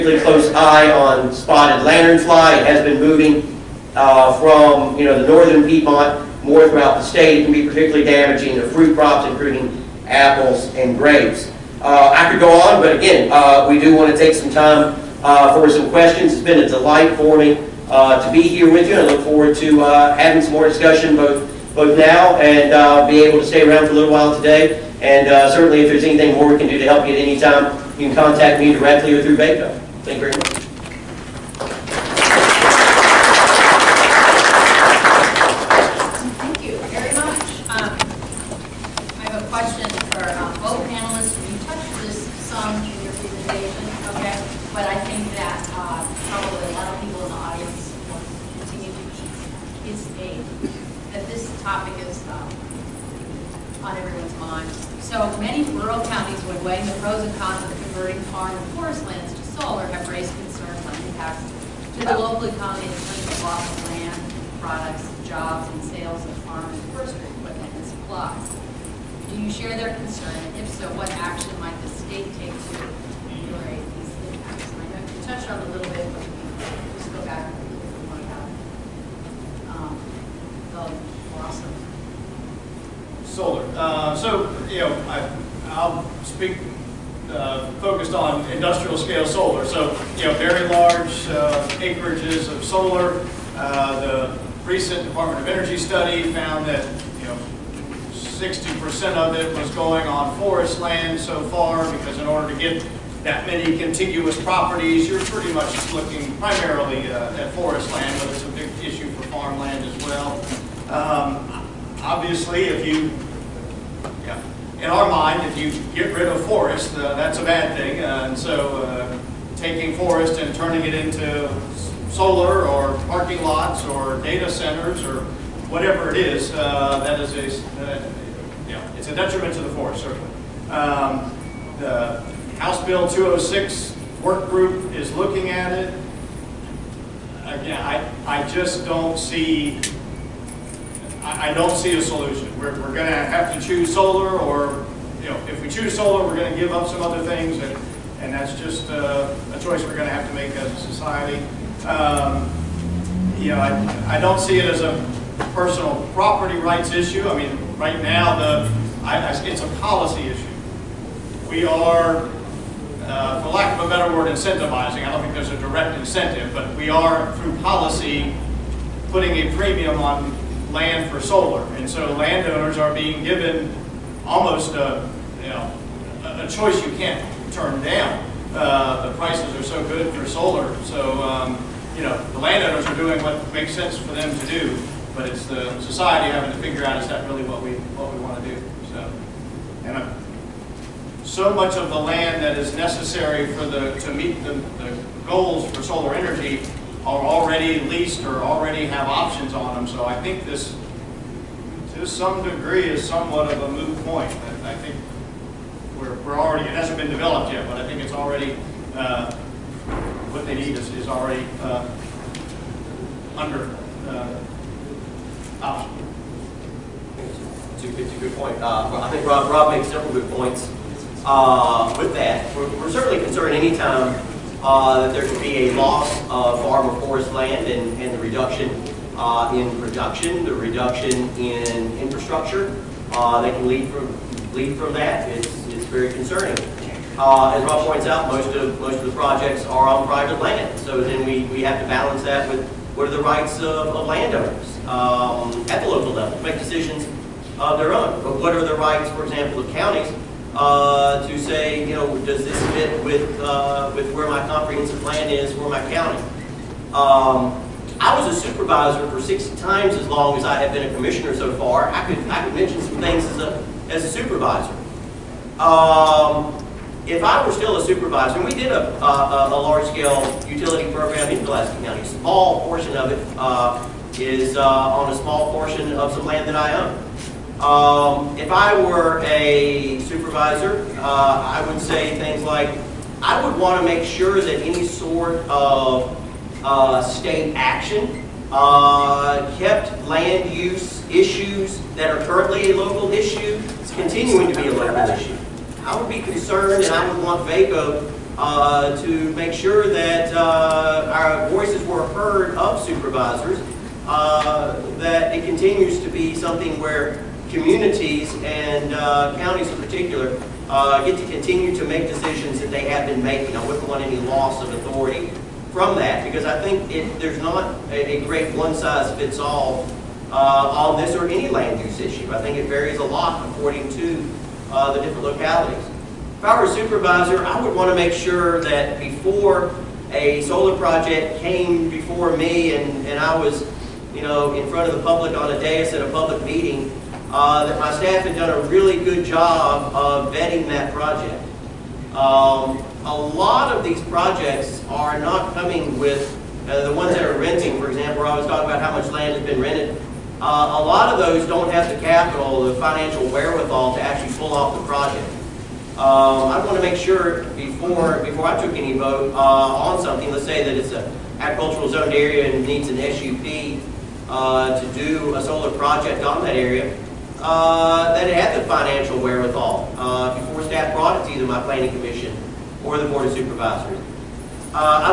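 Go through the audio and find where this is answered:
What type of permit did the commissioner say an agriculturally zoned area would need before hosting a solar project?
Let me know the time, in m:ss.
6:02.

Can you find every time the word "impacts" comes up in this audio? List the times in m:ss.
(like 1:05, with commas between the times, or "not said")
1:01, 1:14.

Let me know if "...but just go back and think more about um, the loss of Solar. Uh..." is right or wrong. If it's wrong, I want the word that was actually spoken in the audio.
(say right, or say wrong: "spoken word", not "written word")
right.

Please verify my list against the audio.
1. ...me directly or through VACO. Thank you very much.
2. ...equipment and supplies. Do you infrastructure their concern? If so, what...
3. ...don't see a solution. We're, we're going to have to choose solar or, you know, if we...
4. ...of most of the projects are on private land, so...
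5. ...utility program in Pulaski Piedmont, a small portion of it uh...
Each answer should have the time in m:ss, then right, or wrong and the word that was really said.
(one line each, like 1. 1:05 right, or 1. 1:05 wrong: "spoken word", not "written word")
1. 0:28 right
2. 1:07 wrong: "share", not "infrastructure"
3. 2:21 right
4. 3:58 right
5. 4:30 wrong: "County", not "Piedmont".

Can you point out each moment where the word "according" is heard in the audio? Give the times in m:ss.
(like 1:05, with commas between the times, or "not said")
5:23.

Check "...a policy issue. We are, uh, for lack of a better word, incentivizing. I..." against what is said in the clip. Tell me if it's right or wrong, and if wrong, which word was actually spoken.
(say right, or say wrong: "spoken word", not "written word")
right.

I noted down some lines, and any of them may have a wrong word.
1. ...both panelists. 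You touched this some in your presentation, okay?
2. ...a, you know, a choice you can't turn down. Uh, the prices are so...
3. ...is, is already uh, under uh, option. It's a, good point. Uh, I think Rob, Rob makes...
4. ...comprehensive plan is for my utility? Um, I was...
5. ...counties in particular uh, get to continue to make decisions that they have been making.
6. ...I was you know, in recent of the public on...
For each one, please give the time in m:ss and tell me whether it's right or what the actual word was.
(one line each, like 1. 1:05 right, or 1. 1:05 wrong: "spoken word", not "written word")
1. 0:40 right
2. 2:54 right
3. 3:30 right
4. 4:14 wrong: "county", not "utility"
5. 5:09 right
6. 5:33 wrong: "front", not "recent".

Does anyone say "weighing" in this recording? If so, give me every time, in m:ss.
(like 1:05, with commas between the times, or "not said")
0:56.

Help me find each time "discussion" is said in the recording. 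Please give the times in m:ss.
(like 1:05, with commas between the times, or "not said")
0:20.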